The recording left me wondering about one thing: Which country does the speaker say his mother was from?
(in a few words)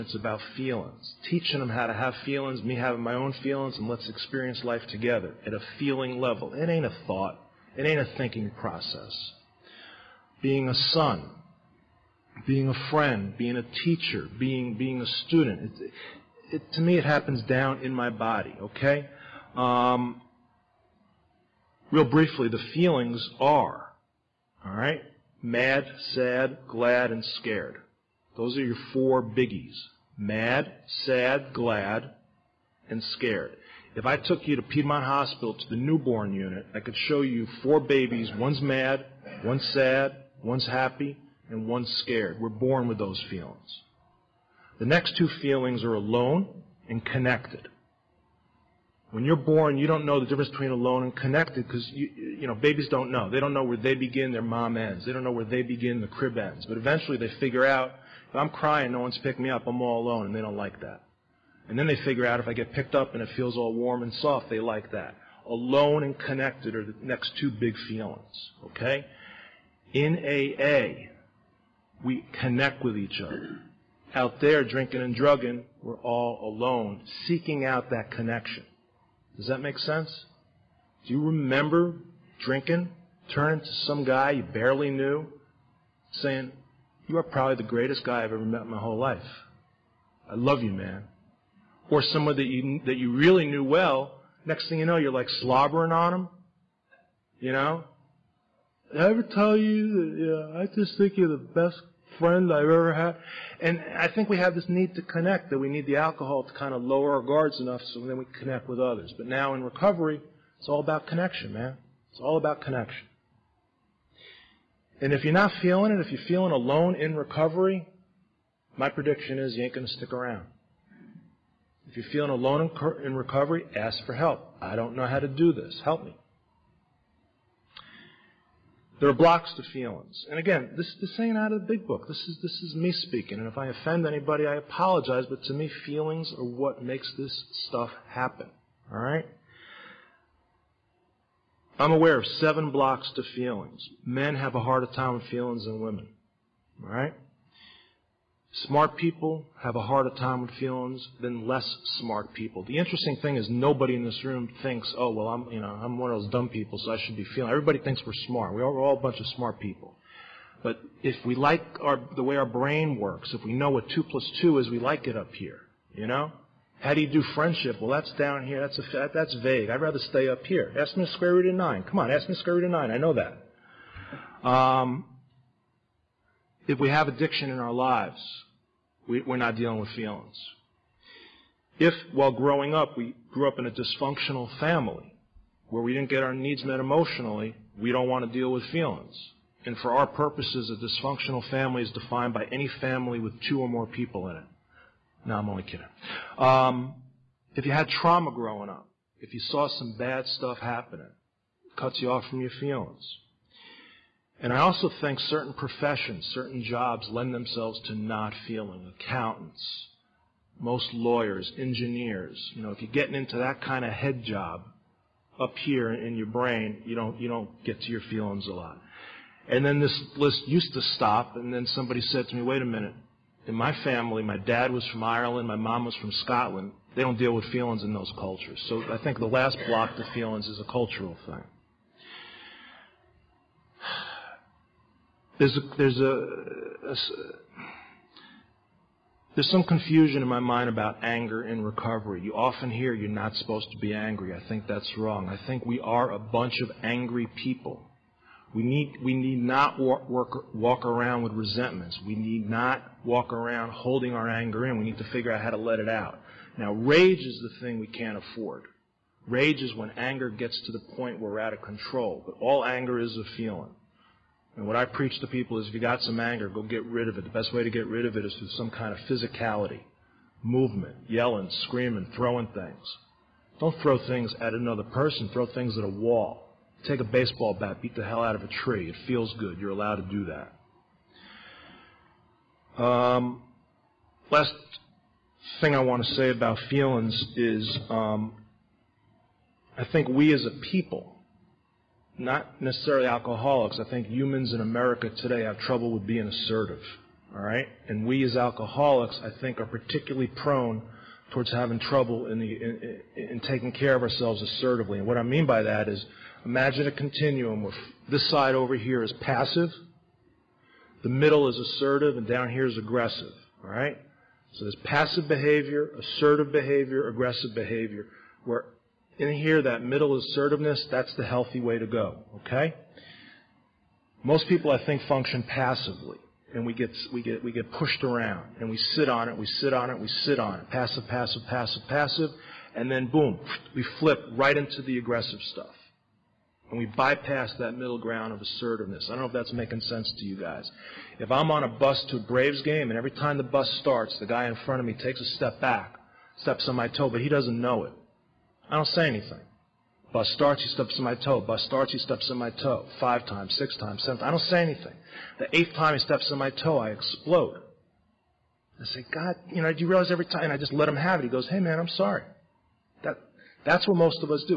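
Scotland.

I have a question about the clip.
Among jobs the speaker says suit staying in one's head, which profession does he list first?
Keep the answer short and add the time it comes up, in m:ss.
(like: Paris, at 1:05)
Accountants, at 3:28.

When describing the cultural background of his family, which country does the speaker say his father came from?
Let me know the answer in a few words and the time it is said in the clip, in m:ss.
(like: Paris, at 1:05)
Ireland, at 3:45.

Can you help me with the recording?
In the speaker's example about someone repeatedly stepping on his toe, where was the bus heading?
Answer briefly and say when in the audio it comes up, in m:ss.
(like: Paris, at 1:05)
A Braves game, at 5:42.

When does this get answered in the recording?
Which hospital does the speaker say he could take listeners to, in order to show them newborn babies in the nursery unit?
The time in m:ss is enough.
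0:34.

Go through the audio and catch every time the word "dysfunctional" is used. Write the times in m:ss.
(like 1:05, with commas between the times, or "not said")
3:03, 3:10.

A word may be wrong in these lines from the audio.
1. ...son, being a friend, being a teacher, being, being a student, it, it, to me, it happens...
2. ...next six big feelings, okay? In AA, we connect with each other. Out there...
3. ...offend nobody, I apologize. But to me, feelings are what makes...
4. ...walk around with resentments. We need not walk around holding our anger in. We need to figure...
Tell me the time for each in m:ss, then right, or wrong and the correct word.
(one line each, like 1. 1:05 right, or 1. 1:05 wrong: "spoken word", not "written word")
1. 0:10 right
2. 1:07 wrong: "two", not "six"
3. 2:13 wrong: "anybody", not "nobody"
4. 4:09 right.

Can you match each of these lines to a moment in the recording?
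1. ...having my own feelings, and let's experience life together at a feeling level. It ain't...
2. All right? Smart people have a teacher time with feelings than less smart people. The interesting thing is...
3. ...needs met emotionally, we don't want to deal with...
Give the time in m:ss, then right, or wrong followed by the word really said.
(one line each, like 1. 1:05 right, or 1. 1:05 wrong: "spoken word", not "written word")
1. 0:02 right
2. 2:26 wrong: "harder", not "teacher"
3. 3:06 right.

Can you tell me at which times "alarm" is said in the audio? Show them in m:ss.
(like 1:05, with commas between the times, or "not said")
not said.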